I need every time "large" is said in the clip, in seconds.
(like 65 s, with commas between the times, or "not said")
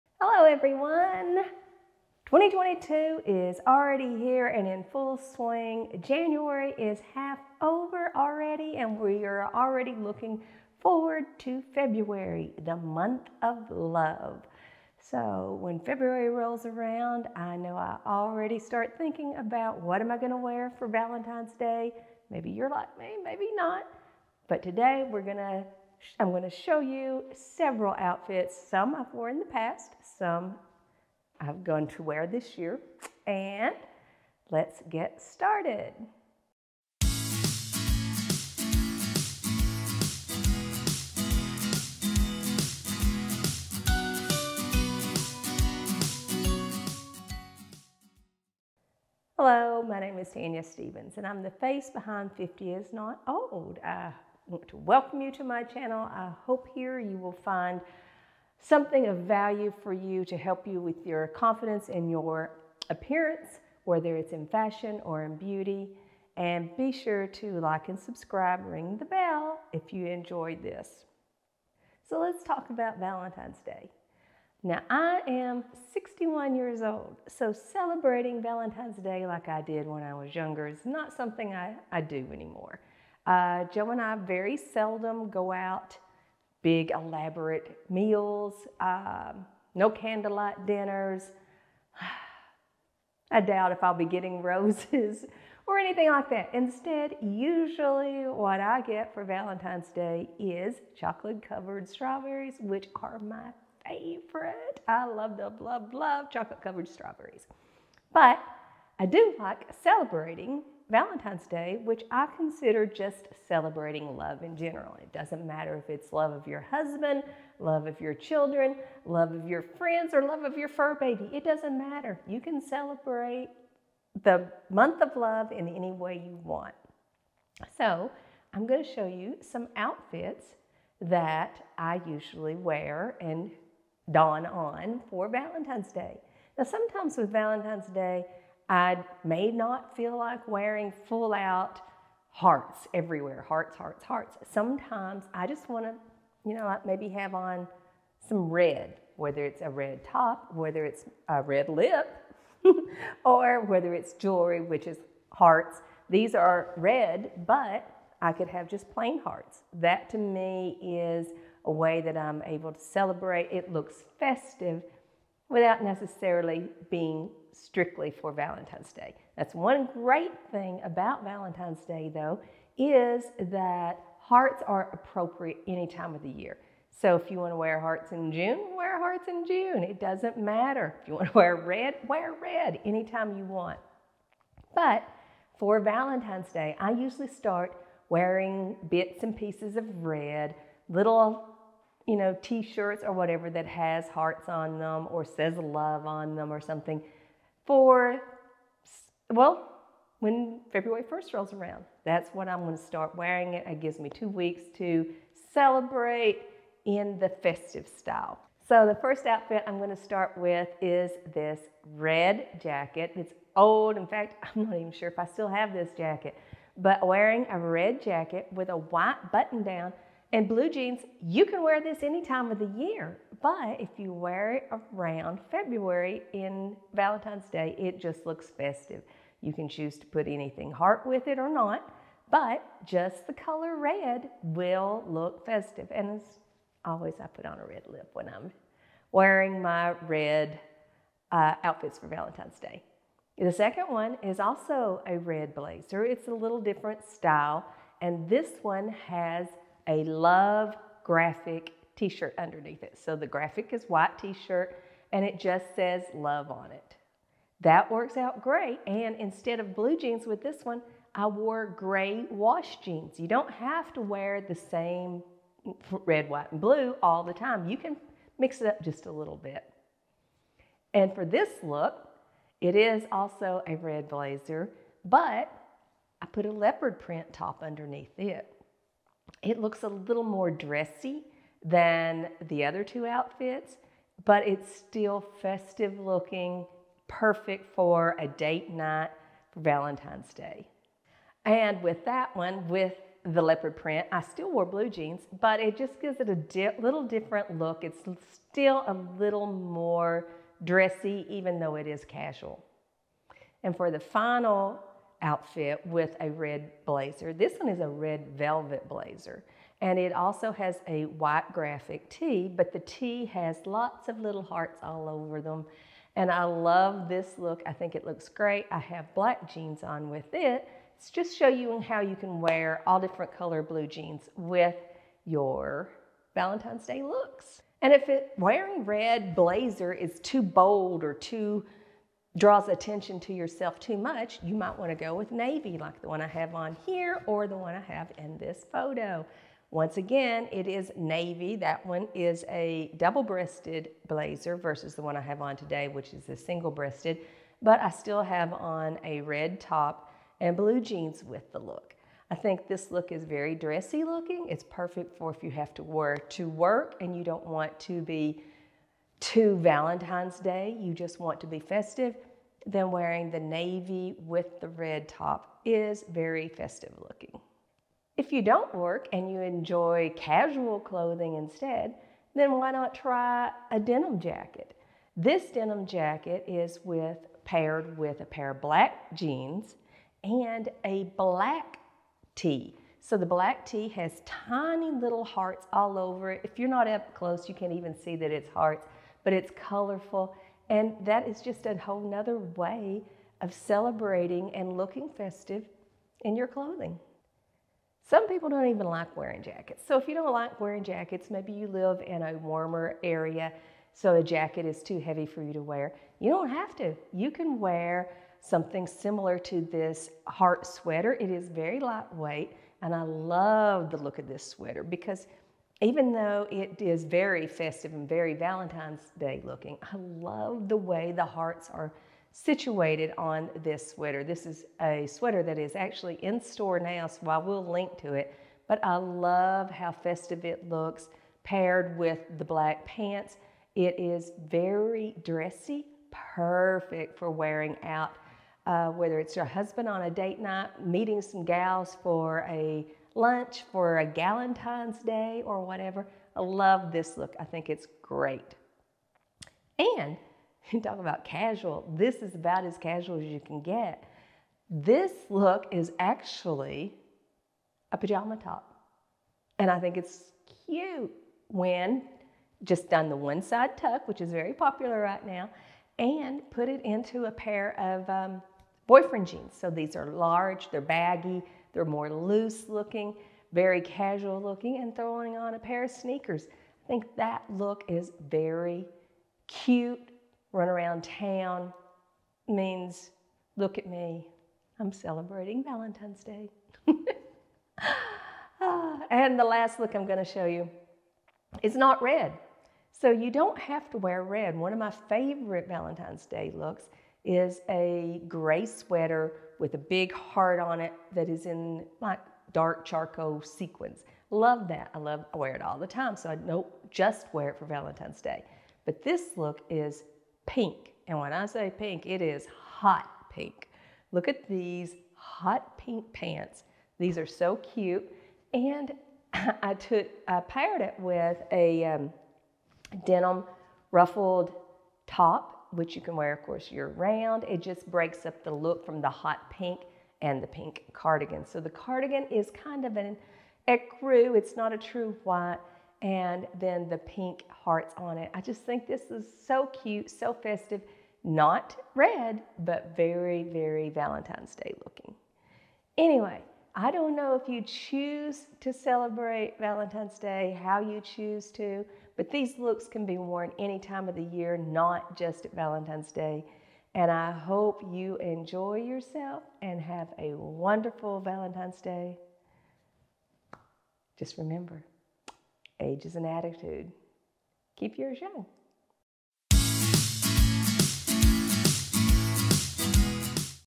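470 s.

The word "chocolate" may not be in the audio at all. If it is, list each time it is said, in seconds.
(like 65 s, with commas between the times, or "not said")
100 s, 106 s.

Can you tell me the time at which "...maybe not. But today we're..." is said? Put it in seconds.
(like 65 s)
23 s.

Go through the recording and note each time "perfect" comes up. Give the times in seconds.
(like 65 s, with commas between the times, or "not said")
287 s, 354 s, 436 s.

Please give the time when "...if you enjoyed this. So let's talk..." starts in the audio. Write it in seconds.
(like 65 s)
69 s.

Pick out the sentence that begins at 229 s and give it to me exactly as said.
You can choose to put anything heart with it or not, but just the color red will look festive.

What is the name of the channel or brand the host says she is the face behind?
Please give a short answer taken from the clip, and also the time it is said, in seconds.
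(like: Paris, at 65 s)
50 is Not Old, at 52 s.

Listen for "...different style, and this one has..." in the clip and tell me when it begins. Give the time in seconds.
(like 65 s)
246 s.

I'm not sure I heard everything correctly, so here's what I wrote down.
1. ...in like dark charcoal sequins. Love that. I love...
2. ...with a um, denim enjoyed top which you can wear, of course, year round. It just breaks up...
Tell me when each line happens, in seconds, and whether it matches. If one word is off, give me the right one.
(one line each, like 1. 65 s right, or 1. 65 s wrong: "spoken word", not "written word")
1. 501 s right
2. 520 s wrong: "ruffled", not "enjoyed".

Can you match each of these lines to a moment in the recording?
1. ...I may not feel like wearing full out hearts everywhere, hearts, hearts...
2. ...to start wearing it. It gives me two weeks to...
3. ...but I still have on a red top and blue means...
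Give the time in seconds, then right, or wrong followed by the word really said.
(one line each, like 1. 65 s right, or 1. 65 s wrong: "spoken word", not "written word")
1. 138 s right
2. 202 s right
3. 347 s wrong: "jeans", not "means".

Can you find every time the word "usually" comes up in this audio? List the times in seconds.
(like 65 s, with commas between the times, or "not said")
97 s, 132 s, 186 s.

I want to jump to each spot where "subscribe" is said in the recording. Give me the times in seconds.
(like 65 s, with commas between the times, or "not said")
67 s.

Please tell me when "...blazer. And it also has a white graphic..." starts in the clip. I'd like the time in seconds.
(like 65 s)
308 s.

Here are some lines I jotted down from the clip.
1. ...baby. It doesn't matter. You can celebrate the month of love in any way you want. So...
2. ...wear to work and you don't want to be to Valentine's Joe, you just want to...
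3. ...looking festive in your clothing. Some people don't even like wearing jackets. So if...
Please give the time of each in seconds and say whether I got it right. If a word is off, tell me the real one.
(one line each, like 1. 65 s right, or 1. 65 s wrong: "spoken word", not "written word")
1. 120 s right
2. 355 s wrong: "Day", not "Joe"
3. 394 s right.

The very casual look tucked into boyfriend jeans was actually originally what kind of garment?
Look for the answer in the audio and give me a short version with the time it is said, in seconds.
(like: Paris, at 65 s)
pajama top, at 457 s.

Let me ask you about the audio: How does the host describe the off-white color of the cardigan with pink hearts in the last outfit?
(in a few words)
ecru.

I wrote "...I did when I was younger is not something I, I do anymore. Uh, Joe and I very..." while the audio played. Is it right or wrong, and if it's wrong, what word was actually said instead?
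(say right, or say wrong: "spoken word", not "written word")
right.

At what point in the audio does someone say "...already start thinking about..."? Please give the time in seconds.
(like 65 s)
18 s.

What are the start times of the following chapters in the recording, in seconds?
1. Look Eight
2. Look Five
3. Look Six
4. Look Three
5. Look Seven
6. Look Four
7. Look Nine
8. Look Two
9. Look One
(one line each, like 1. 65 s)
1. 455 s
2. 336 s
3. 374 s
4. 276 s
5. 409 s
6. 307 s
7. 491 s
8. 249 s
9. 214 s.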